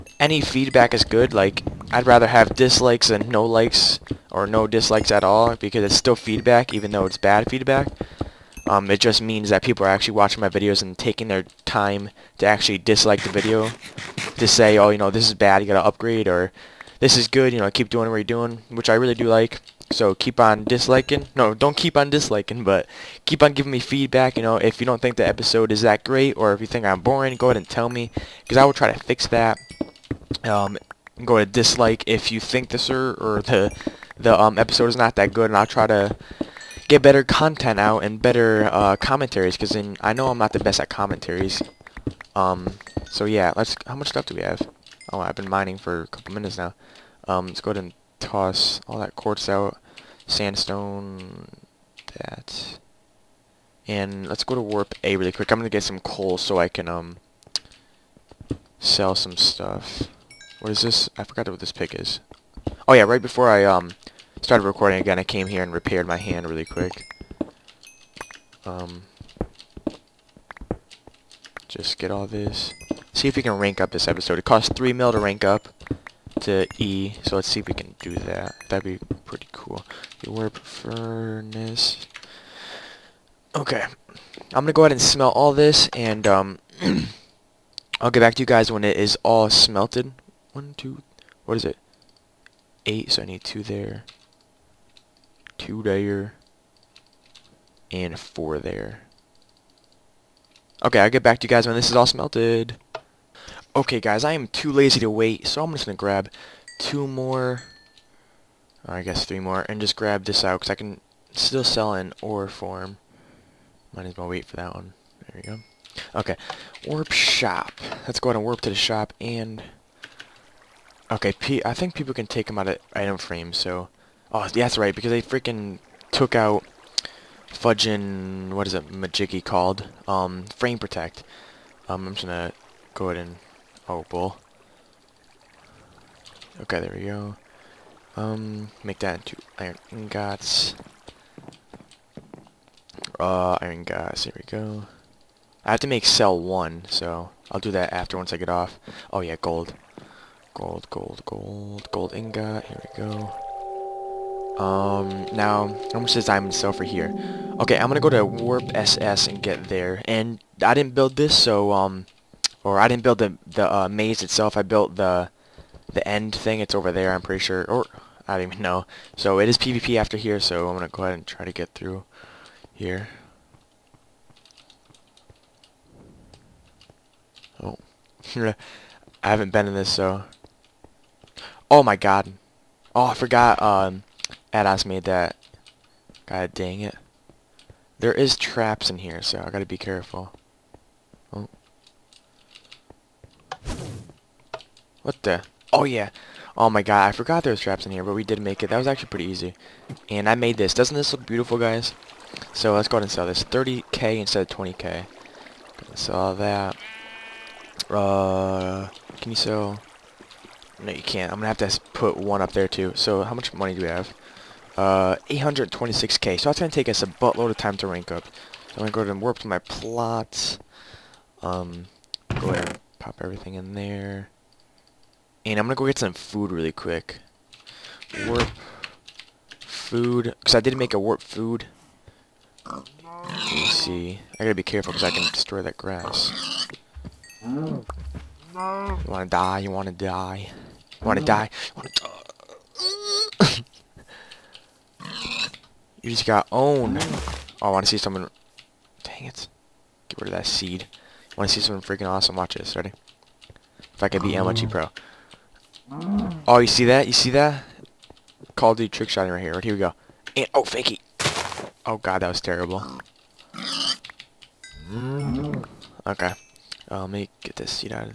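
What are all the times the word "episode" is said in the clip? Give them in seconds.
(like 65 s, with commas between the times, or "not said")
25 s, 34 s, 74 s.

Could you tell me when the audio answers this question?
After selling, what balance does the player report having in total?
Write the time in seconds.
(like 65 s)
214 s.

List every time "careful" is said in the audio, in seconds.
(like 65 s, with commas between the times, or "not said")
189 s, 234 s.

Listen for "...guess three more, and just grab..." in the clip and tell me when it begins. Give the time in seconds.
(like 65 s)
109 s.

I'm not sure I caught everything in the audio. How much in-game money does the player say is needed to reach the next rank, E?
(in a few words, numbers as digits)
3 mil.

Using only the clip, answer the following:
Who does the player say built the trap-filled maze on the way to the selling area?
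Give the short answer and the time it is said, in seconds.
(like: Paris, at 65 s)
Adas, at 184 s.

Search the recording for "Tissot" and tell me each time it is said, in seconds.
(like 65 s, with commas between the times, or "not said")
not said.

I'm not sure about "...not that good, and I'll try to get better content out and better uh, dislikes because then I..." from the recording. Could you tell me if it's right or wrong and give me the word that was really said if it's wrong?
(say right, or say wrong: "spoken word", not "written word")
wrong: "commentaries", not "dislikes".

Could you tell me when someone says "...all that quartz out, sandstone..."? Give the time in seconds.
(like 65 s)
48 s.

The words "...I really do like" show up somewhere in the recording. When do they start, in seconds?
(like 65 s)
18 s.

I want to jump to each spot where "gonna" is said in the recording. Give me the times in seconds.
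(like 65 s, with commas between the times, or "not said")
55 s, 84 s, 132 s, 157 s, 170 s, 211 s.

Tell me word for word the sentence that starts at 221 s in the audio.
Um, go ahead and pop everything in there.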